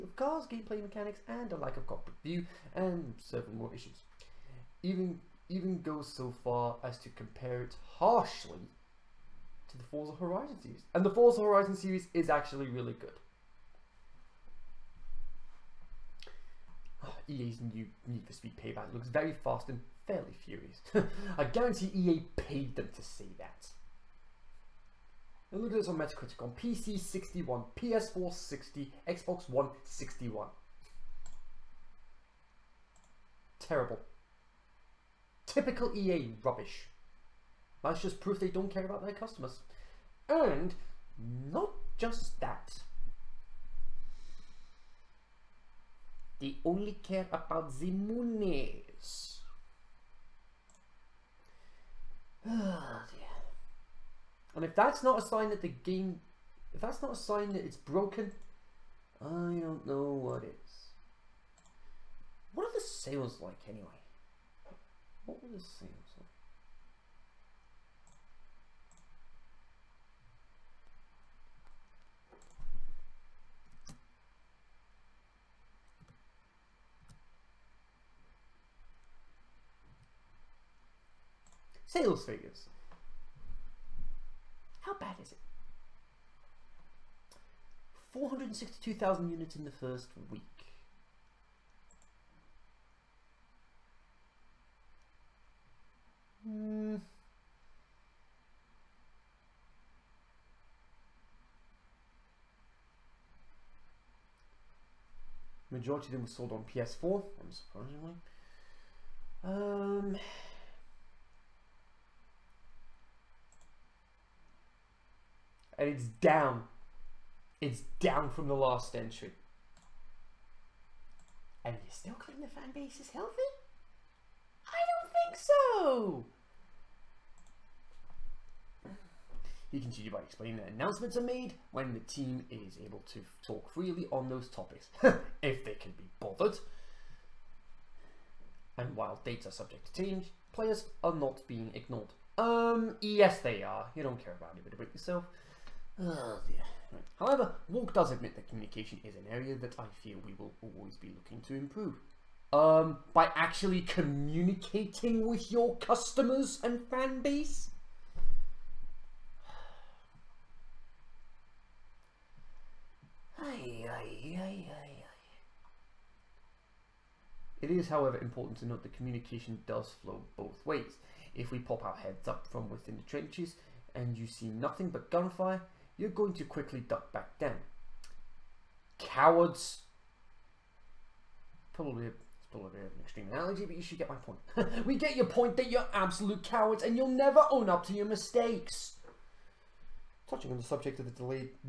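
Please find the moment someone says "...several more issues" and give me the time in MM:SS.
00:03.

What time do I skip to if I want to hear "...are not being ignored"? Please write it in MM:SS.
02:21.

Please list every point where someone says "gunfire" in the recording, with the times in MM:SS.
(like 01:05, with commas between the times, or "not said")
02:55.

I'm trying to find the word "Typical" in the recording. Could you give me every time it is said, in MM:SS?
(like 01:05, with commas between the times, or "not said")
00:35.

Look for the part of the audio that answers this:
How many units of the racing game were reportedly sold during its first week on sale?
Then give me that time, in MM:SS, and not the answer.
01:28.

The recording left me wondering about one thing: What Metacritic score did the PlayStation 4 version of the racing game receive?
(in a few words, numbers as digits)
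60.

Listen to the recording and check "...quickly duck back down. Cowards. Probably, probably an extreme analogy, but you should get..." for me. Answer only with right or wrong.
right.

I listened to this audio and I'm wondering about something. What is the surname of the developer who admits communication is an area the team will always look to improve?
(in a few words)
Walke.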